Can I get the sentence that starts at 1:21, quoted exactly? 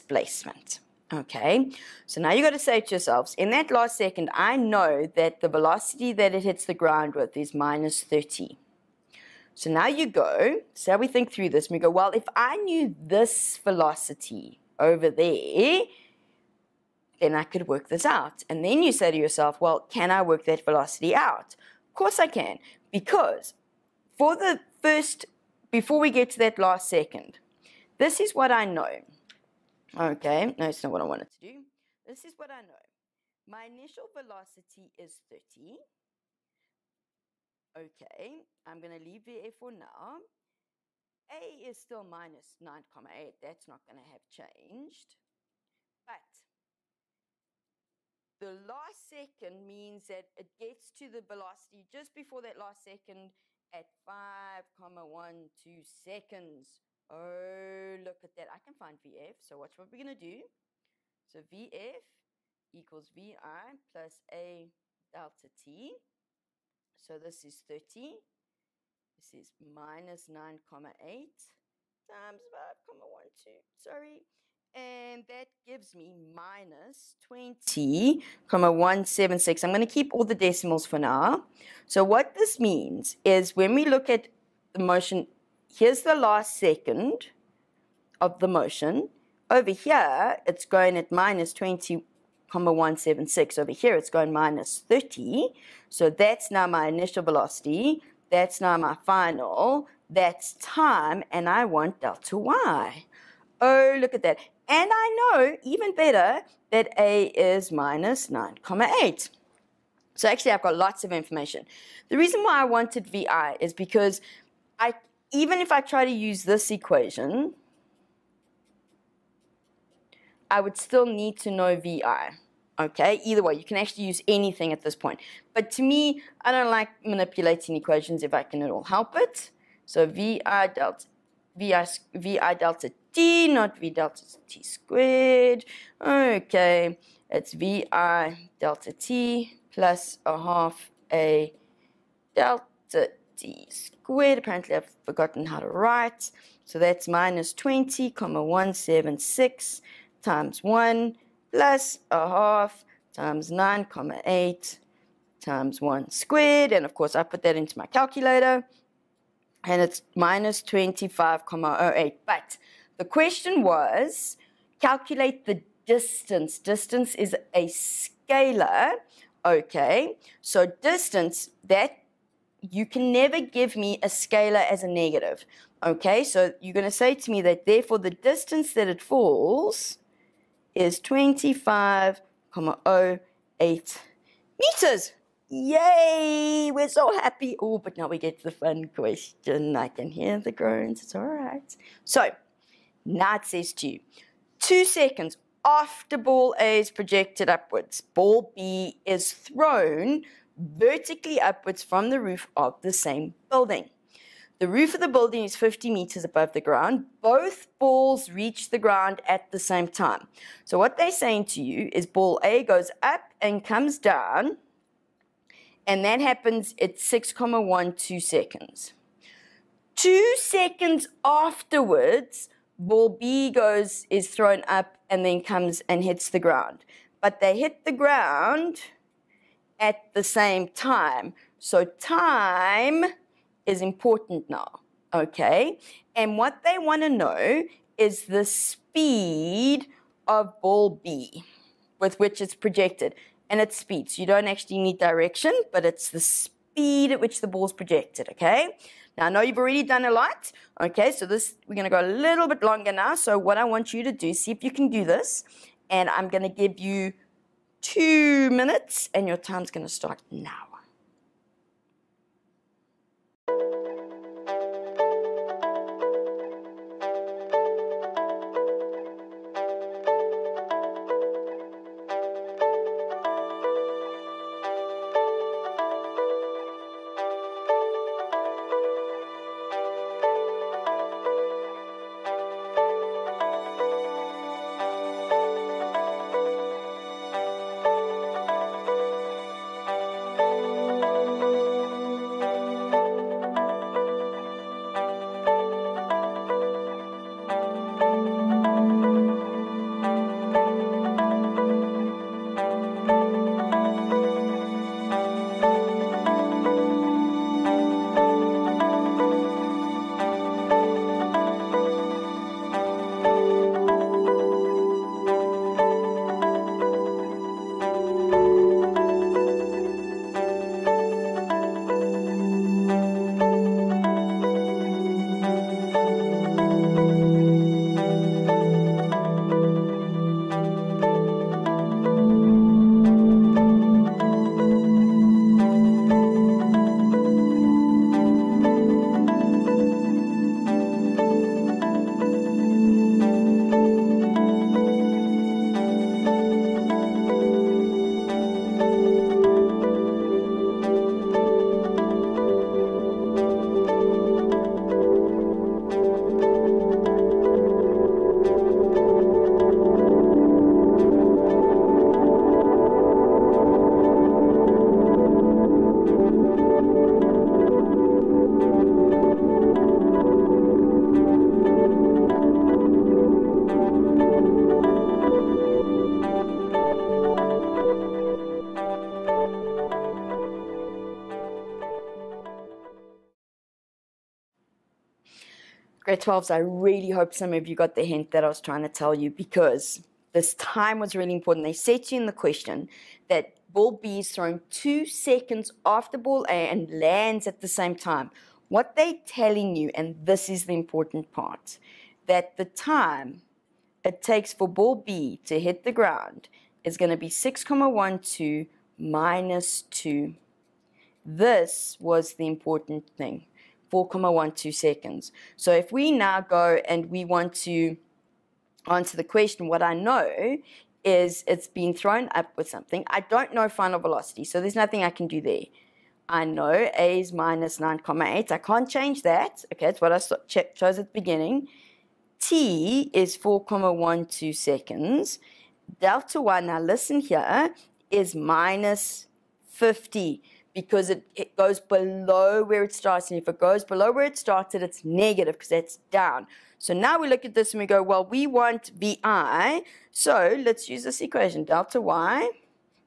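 So what this means is when we look at the motion, here's the last second of the motion.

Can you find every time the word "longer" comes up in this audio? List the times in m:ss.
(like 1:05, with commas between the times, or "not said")
4:12.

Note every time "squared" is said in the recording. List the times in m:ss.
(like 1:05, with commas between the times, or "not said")
2:14, 2:23, 2:36.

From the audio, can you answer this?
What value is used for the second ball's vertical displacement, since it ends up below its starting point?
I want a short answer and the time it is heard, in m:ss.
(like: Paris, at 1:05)
-50, at 7:18.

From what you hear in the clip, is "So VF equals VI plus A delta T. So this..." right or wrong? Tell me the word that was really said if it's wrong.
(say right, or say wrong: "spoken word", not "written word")
right.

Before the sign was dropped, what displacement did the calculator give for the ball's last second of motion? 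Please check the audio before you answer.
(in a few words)
-25,08.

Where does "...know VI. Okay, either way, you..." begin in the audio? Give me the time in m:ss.
2:01.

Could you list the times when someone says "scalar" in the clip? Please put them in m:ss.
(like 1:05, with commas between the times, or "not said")
2:47, 2:54.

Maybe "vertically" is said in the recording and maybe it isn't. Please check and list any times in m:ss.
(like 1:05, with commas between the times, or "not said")
3:20.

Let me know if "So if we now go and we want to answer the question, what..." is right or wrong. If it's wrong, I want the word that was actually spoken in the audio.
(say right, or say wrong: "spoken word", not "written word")
right.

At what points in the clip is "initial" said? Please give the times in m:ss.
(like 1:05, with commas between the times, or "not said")
0:33, 1:36.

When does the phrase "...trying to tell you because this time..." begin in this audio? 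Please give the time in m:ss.
6:28.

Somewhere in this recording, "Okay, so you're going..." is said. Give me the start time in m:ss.
2:55.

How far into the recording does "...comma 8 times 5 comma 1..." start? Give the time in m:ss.
1:10.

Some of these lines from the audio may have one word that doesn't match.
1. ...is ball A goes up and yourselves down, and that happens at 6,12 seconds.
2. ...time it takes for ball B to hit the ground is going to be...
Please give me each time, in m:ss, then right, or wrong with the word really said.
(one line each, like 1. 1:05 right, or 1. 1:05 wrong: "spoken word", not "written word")
1. 3:31 wrong: "comes", not "yourselves"
2. 6:42 right.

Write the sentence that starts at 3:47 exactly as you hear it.
But they hit the ground at the same time.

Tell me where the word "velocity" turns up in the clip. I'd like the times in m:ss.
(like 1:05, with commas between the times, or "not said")
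0:05, 0:13, 0:20, 0:34, 0:51, 1:37, 7:03.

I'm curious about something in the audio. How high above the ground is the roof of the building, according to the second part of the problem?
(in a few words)
50 meters.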